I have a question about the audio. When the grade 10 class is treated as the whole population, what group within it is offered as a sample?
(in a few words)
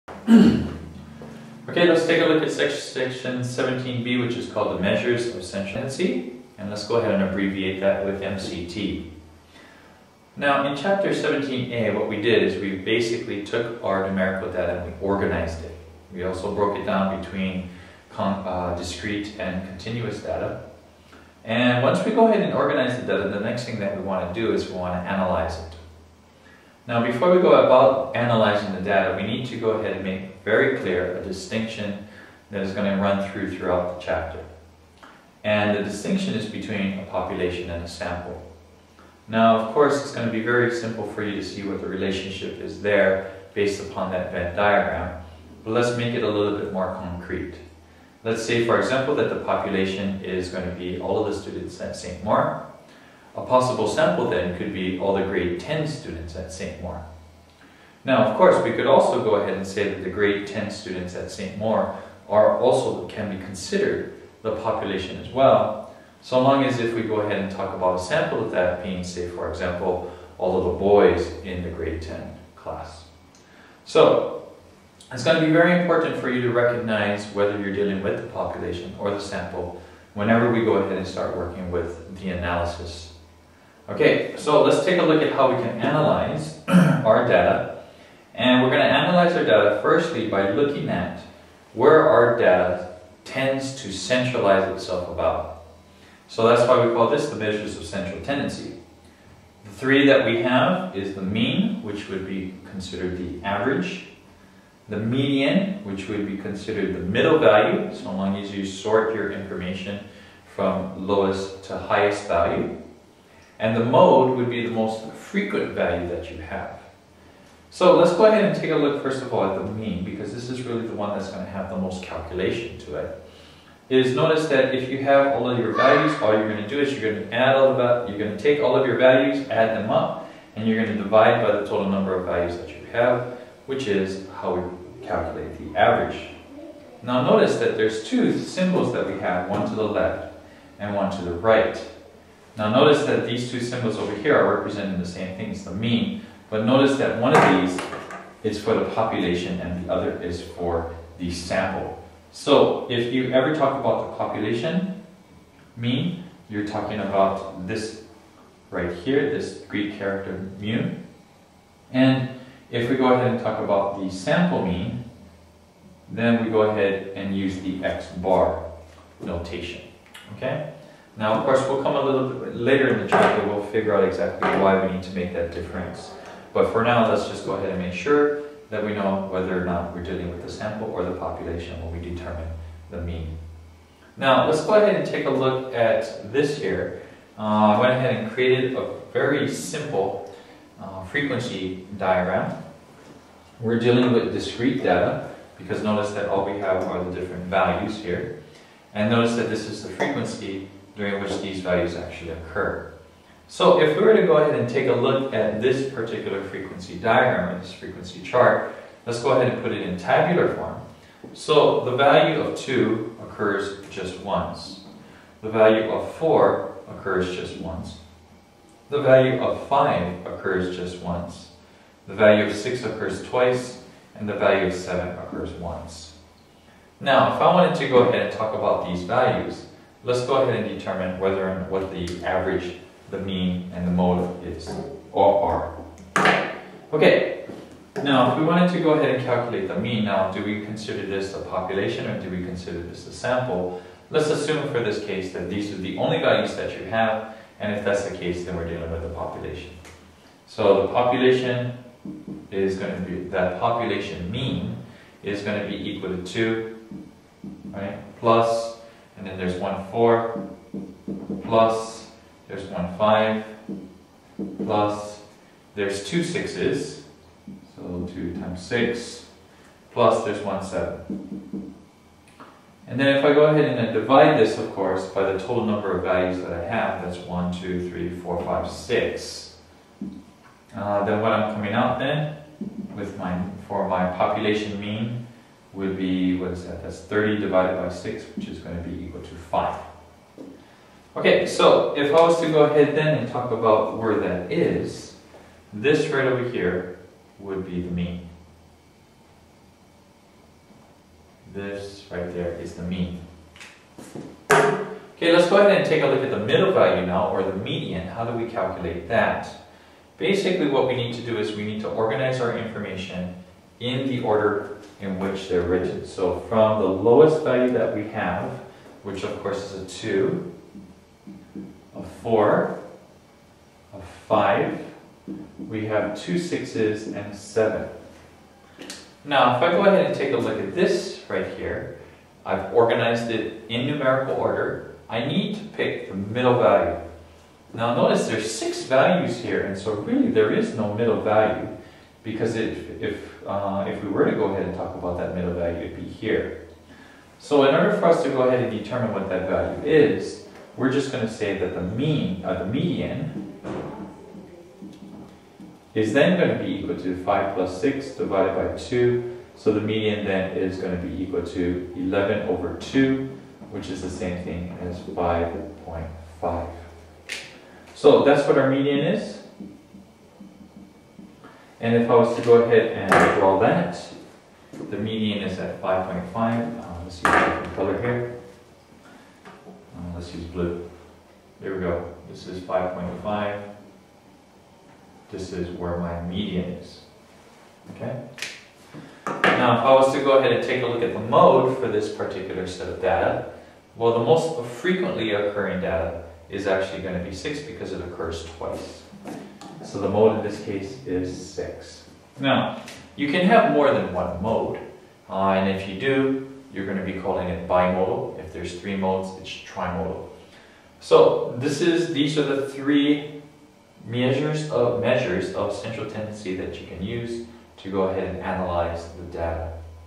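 All of the boys.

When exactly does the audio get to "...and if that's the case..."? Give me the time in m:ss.
4:07.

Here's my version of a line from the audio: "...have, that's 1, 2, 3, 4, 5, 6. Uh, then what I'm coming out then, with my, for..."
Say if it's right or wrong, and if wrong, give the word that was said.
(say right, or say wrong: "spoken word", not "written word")
right.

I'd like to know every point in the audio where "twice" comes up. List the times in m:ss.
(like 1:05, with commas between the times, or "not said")
3:43, 6:38.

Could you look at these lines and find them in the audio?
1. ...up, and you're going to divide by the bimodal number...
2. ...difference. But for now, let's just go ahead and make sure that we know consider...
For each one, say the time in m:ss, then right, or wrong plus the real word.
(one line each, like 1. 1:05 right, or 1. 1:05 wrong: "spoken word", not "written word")
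1. 2:09 wrong: "total", not "bimodal"
2. 2:55 wrong: "whether", not "consider".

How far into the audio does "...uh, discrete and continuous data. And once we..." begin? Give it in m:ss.
0:18.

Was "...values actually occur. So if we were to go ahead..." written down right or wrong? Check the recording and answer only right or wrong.
right.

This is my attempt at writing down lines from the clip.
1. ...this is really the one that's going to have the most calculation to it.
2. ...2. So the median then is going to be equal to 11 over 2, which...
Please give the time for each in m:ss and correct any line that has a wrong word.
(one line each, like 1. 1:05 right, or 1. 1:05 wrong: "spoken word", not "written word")
1. 2:00 right
2. 5:58 right.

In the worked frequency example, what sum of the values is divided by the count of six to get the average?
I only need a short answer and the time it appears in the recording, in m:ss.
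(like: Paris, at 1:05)
30, at 4:46.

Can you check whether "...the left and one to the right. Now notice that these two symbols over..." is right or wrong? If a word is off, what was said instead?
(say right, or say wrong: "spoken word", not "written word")
right.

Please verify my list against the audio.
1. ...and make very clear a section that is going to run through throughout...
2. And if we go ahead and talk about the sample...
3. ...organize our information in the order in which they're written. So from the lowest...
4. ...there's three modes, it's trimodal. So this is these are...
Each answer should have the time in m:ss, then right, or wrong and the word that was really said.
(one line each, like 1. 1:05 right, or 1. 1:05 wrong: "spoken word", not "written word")
1. 0:29 wrong: "distinction", not "section"
2. 2:41 right
3. 5:11 right
4. 6:48 right.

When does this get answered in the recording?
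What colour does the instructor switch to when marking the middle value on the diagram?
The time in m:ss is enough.
6:20.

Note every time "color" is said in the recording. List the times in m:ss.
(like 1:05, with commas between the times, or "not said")
6:17.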